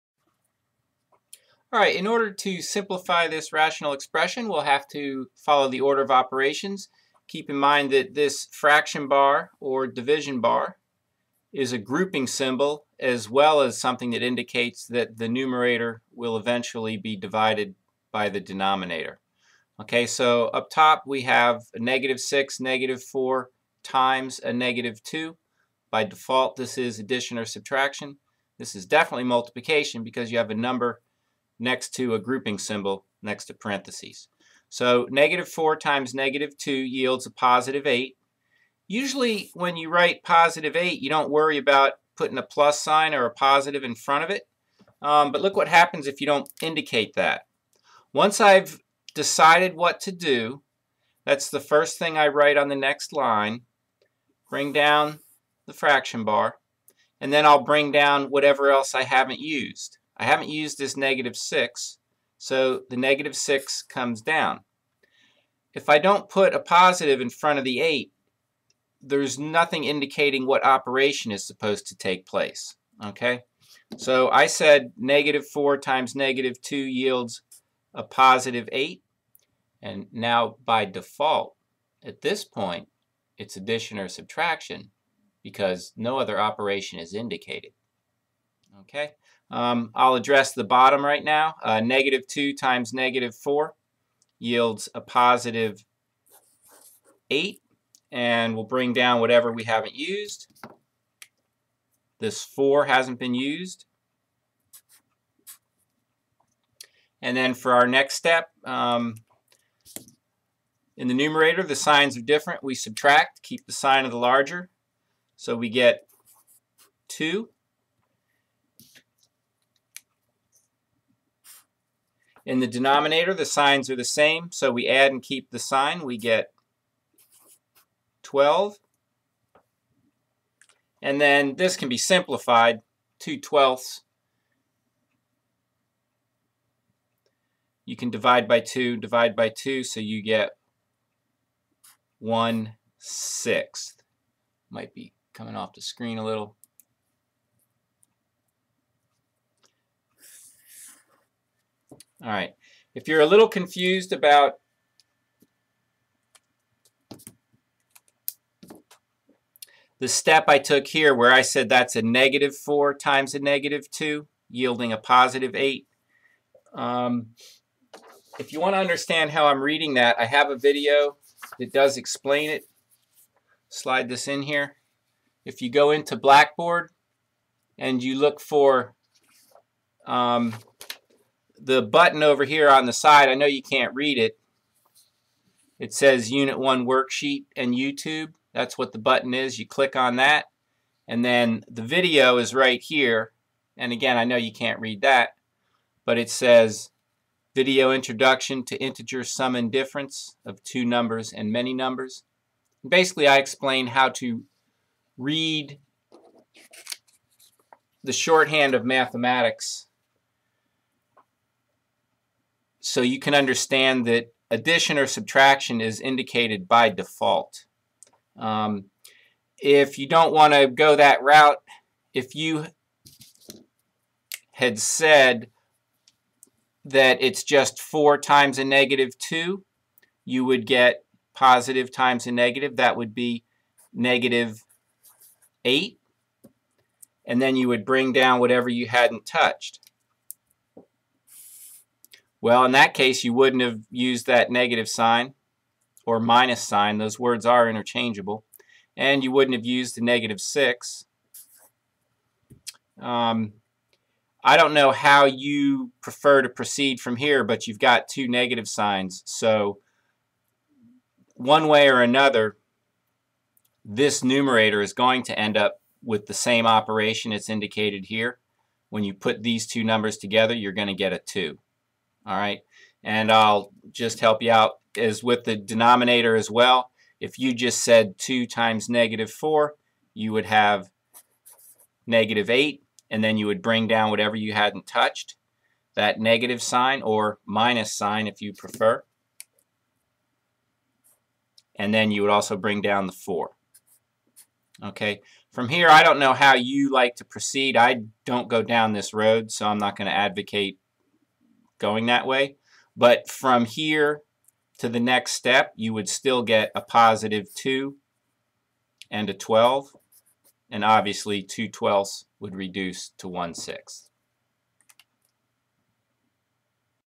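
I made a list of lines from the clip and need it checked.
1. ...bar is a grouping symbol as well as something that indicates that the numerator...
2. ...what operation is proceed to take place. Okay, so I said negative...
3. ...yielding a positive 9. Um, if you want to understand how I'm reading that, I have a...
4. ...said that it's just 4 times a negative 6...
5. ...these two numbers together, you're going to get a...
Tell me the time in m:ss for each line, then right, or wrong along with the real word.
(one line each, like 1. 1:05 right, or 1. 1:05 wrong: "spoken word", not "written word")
1. 0:10 right
2. 1:10 wrong: "supposed", not "proceed"
3. 2:44 wrong: "8", not "9"
4. 3:44 wrong: "2", not "6"
5. 4:29 right.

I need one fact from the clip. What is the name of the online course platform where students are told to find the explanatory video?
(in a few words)
Blackboard.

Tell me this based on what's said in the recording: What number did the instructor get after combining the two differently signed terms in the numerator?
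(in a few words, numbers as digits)
2.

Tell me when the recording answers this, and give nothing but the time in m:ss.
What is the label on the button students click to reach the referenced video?
3:06.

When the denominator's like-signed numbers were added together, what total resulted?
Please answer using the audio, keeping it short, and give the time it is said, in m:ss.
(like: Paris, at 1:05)
12, at 2:06.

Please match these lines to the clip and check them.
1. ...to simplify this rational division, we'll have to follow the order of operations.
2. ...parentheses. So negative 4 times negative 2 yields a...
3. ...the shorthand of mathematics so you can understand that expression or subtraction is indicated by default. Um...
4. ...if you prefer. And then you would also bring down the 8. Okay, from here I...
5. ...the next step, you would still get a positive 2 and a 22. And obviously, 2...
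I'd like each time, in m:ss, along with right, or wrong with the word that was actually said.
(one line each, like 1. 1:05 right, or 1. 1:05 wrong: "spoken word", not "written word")
1. 0:02 wrong: "expression", not "division"
2. 0:33 right
3. 3:28 wrong: "addition", not "expression"
4. 4:48 wrong: "4", not "8"
5. 5:04 wrong: "12", not "22".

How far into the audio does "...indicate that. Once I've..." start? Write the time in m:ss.
0:46.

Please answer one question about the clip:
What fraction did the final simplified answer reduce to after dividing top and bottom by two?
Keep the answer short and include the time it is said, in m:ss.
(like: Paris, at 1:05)
1/6, at 2:19.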